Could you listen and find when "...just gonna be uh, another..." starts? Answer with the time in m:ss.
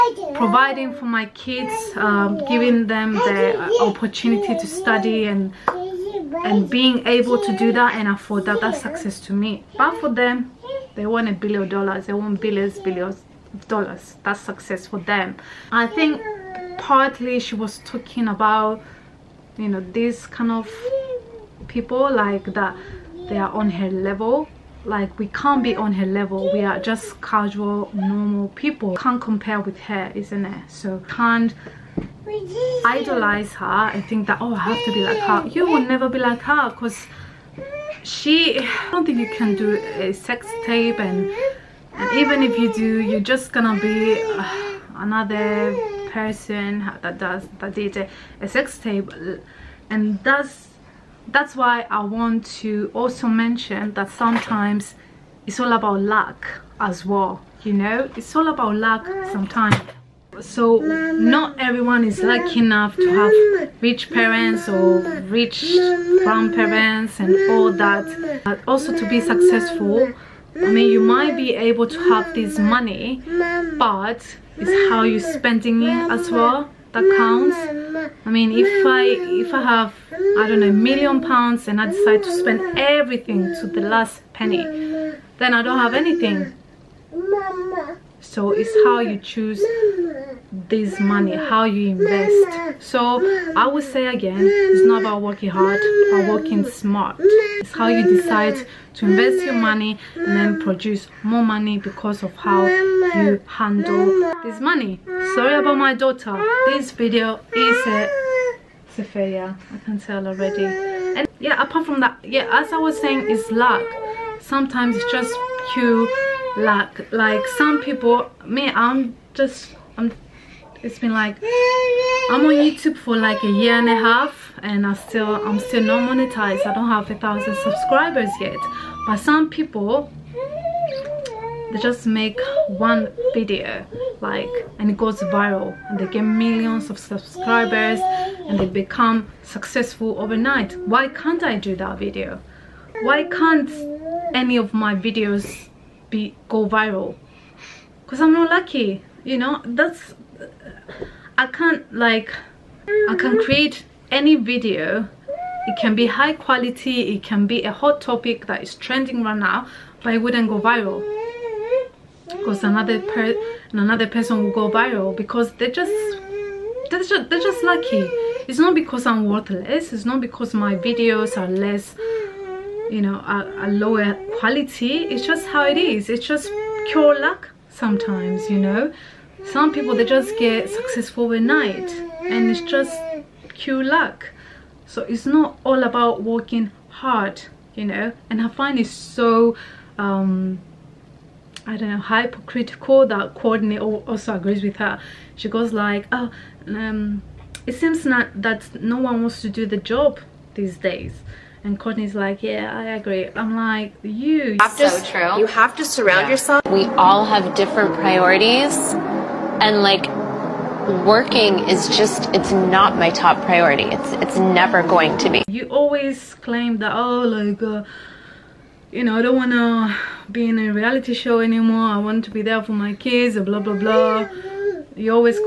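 0:43.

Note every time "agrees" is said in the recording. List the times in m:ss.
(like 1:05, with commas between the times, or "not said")
3:14, 3:22.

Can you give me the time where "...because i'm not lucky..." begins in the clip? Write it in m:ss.
2:28.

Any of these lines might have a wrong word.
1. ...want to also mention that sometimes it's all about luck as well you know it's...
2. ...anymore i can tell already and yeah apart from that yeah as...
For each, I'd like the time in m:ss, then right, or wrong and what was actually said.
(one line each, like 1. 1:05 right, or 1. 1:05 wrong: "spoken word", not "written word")
1. 0:52 right
2. 1:49 wrong: "failure", not "anymore".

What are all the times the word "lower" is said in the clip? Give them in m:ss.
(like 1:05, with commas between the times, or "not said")
2:53.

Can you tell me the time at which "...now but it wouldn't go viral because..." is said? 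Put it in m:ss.
2:39.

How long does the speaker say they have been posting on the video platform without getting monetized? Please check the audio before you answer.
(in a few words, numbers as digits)
a year and a half.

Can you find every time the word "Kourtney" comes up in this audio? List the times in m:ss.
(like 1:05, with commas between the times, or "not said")
3:13, 3:21.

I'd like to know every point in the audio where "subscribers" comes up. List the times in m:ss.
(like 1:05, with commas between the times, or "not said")
2:07, 2:16.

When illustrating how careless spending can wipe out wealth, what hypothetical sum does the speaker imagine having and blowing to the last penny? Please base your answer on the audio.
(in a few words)
1,000,000 pounds.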